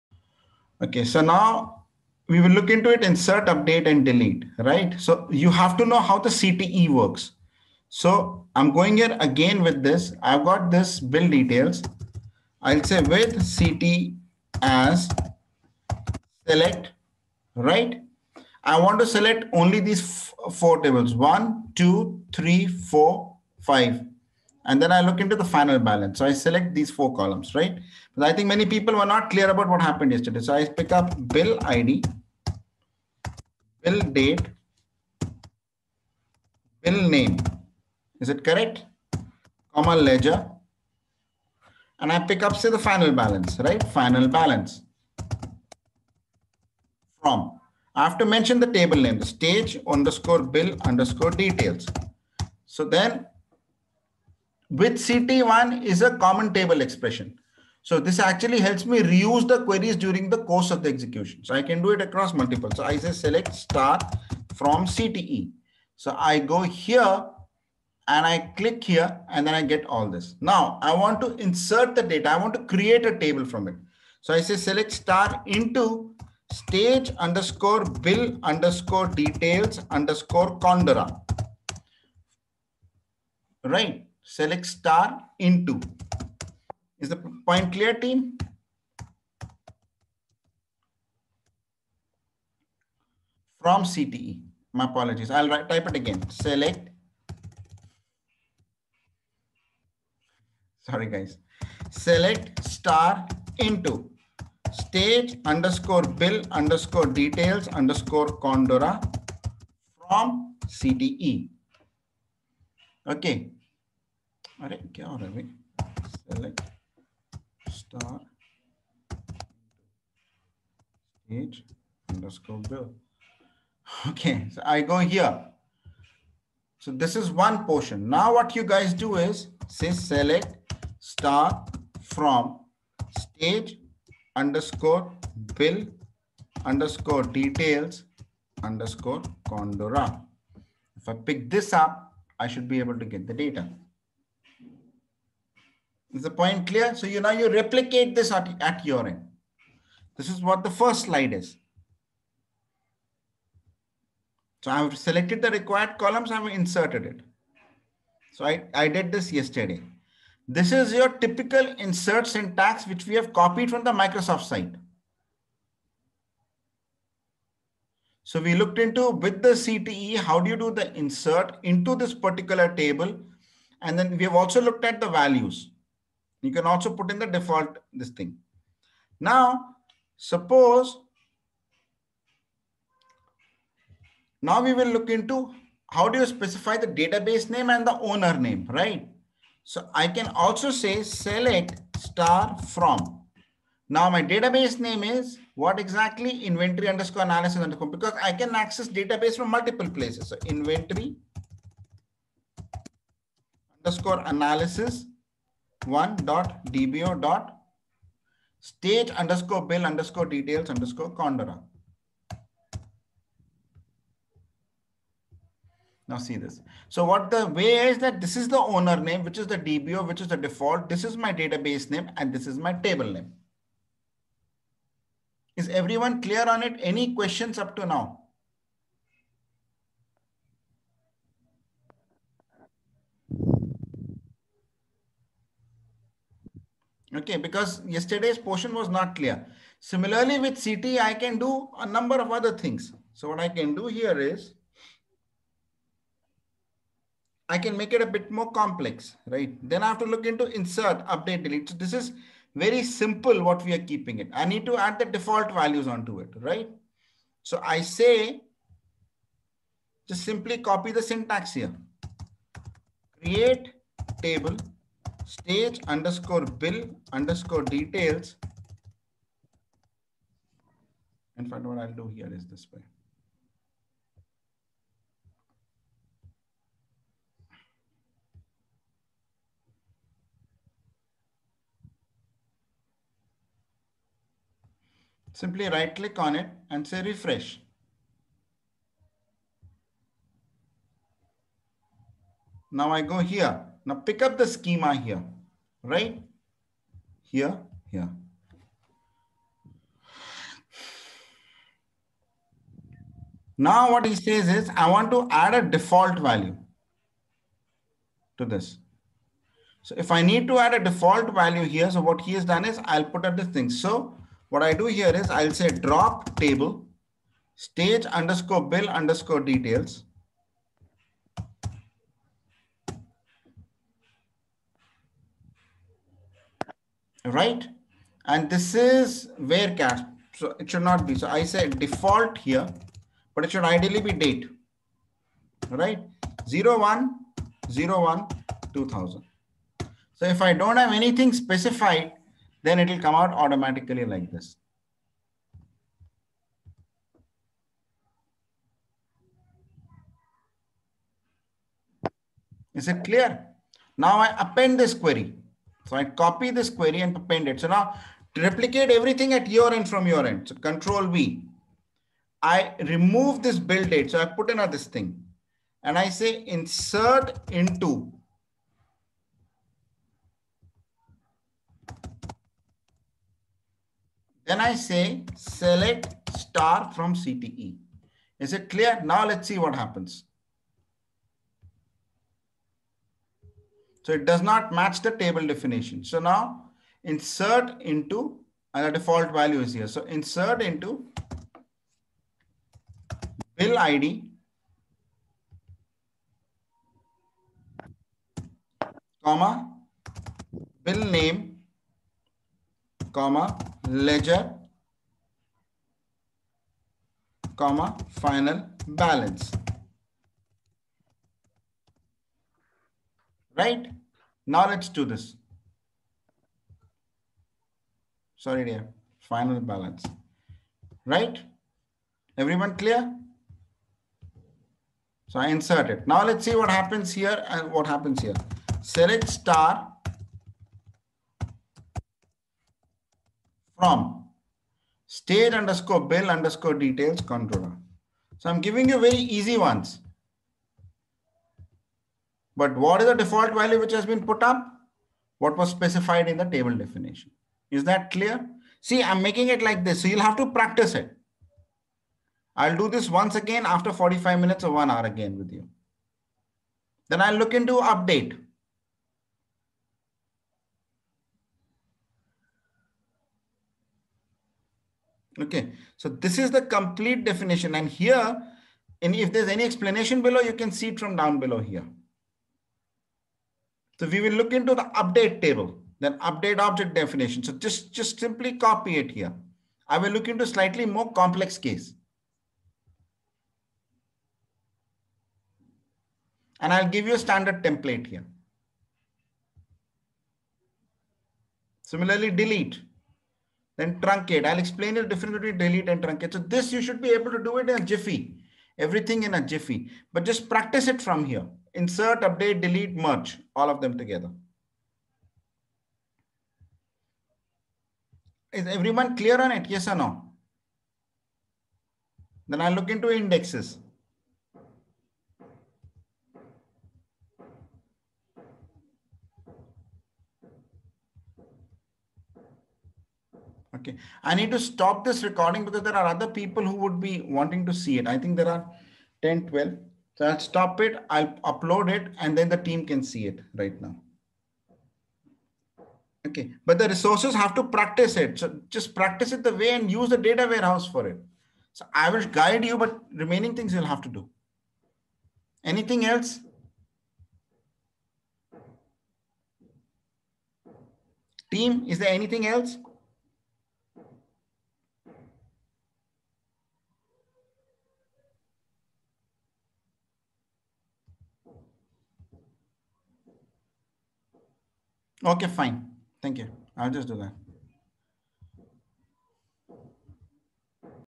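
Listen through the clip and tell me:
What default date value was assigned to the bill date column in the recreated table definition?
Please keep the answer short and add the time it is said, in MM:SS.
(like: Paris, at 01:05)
01/01/2000, at 05:36.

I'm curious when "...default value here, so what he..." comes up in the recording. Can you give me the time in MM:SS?
05:10.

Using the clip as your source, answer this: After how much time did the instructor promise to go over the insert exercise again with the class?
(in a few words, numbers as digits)
45 minutes.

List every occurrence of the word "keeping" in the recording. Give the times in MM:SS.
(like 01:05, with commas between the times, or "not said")
04:13.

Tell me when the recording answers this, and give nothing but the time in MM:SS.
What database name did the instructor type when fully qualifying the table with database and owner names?
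03:20.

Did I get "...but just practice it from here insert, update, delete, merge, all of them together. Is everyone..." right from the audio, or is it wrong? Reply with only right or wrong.
right.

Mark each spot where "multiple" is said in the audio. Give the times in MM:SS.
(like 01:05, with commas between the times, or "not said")
01:02, 03:19.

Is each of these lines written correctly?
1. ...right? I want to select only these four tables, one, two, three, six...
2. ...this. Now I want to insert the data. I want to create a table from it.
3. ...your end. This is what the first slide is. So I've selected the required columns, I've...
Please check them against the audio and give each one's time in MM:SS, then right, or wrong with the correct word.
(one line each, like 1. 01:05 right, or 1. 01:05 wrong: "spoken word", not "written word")
1. 00:17 wrong: "four", not "six"
2. 01:10 right
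3. 02:28 right.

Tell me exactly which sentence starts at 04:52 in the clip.
Now I go here now pick up the schema here, right?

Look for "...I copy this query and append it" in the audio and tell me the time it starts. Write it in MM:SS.
05:55.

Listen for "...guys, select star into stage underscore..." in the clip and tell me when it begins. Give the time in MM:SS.
01:41.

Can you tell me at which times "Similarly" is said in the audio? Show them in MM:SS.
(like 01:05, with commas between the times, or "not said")
03:59, 08:11.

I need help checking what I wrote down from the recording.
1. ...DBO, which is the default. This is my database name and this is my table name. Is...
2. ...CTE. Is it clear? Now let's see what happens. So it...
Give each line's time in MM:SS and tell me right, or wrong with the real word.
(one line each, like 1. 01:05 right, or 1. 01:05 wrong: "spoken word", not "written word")
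1. 03:39 right
2. 06:17 right.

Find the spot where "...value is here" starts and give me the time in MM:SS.
06:29.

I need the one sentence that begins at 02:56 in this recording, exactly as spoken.
You can also put in the default this thing.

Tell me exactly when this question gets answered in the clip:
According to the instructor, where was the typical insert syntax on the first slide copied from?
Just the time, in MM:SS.
02:43.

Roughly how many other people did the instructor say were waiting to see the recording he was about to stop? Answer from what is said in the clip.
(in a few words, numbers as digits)
10 to 12.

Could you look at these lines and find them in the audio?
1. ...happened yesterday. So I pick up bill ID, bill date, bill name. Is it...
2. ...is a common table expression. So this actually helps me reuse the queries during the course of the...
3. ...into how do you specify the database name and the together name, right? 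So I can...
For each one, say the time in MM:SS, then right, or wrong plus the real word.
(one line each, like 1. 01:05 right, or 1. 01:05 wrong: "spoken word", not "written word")
1. 00:29 right
2. 00:55 right
3. 03:05 wrong: "owner", not "together".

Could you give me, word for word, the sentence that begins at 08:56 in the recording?
Okay, but the resources have to practice it.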